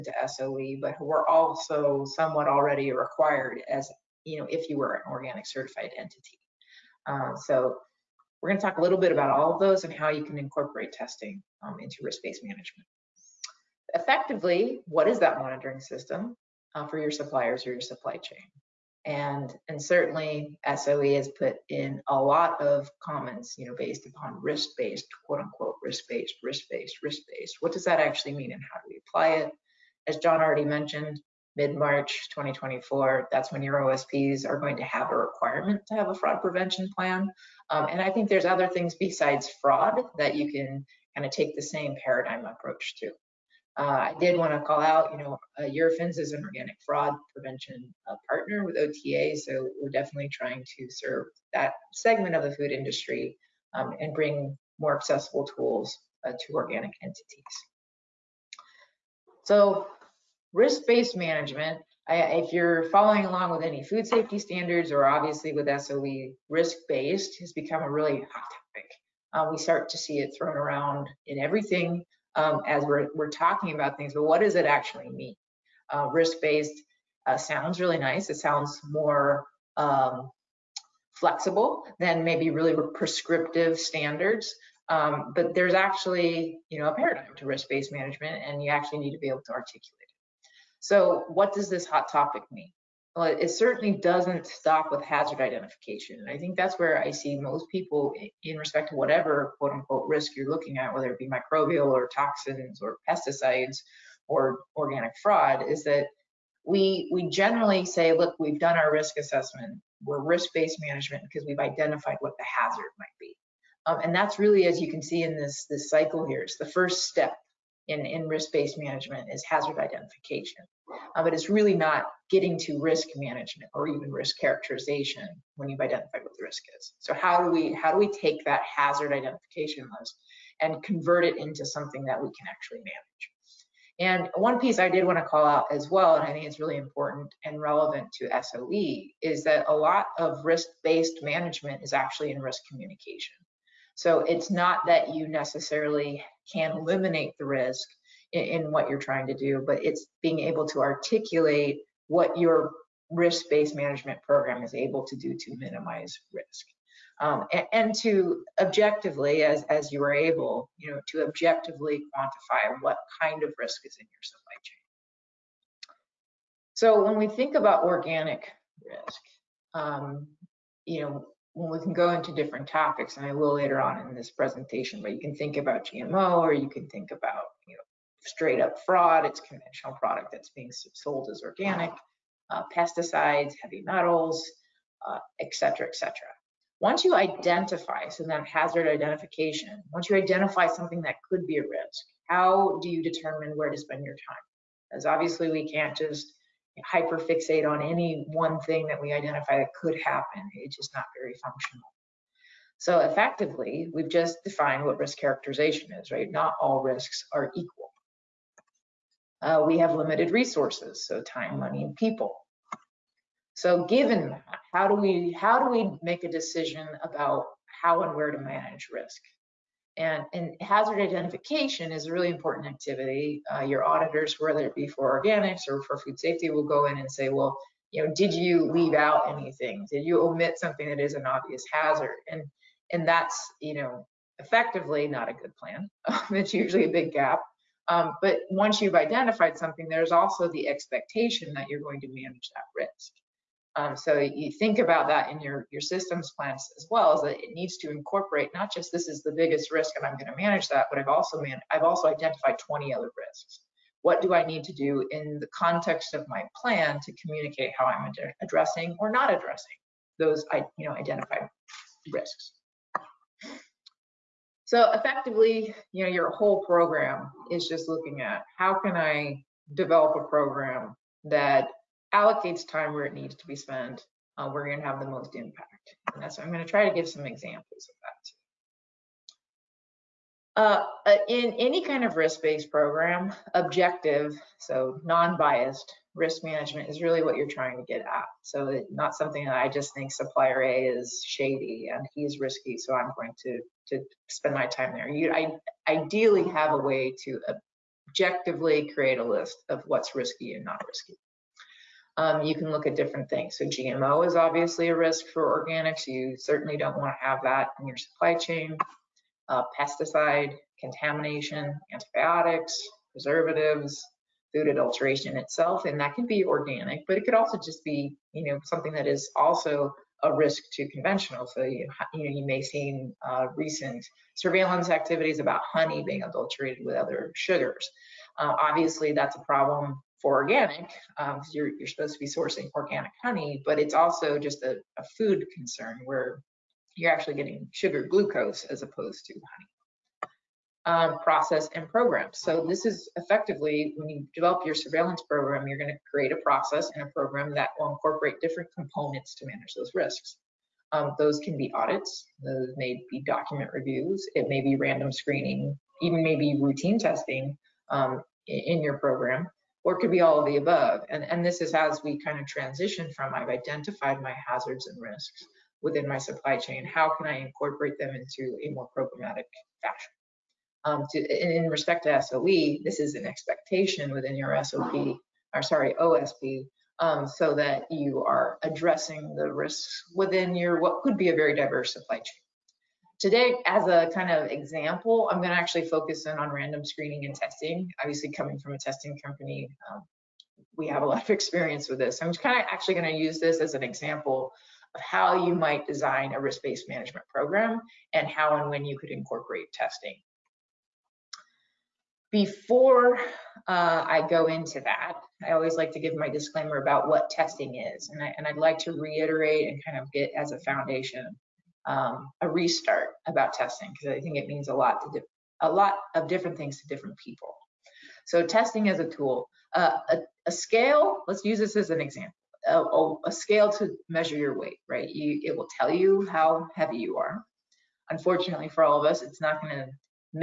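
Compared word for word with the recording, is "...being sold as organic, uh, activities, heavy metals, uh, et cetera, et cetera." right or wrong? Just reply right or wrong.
wrong.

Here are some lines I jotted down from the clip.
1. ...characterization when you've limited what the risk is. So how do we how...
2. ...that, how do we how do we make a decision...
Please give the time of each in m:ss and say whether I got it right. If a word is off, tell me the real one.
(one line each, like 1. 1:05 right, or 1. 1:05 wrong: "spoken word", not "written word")
1. 2:04 wrong: "identified", not "limited"
2. 3:34 right.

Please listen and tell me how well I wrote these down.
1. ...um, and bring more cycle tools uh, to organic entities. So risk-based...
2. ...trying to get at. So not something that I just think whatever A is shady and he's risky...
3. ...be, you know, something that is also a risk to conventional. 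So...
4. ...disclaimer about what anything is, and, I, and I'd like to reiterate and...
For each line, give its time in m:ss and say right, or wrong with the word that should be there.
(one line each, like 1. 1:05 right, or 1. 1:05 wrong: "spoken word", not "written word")
1. 0:53 wrong: "accessible", not "cycle"
2. 4:47 wrong: "supplier", not "whatever"
3. 5:17 right
4. 6:46 wrong: "testing", not "anything".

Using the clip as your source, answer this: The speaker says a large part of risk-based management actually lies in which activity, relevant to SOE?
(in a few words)
risk communication.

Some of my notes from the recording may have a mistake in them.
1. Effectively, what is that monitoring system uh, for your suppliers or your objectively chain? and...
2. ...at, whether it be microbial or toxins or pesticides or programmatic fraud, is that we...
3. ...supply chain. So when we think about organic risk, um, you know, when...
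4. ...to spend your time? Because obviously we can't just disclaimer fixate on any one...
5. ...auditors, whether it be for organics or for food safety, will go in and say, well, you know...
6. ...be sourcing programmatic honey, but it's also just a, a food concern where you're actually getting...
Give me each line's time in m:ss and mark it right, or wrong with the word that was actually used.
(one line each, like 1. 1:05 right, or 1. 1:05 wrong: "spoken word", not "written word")
1. 0:13 wrong: "supply", not "objectively"
2. 1:40 wrong: "organic", not "programmatic"
3. 2:44 right
4. 3:13 wrong: "hyper", not "disclaimer"
5. 3:43 right
6. 5:32 wrong: "organic", not "programmatic".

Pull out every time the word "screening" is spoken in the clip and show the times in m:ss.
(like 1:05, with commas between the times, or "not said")
5:55, 6:26.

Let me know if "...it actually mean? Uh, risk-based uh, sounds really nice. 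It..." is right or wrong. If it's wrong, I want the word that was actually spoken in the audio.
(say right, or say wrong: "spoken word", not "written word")
right.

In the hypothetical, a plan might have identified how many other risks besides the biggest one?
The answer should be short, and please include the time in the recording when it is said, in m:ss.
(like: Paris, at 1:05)
20, at 4:12.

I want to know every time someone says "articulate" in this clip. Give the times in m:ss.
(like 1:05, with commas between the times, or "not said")
1:29, 2:30.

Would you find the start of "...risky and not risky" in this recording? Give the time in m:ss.
5:00.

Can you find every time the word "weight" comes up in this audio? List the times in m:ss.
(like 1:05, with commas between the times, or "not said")
7:04.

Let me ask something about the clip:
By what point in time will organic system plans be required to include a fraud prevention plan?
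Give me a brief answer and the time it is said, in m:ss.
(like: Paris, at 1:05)
mid-March 2024, at 0:31.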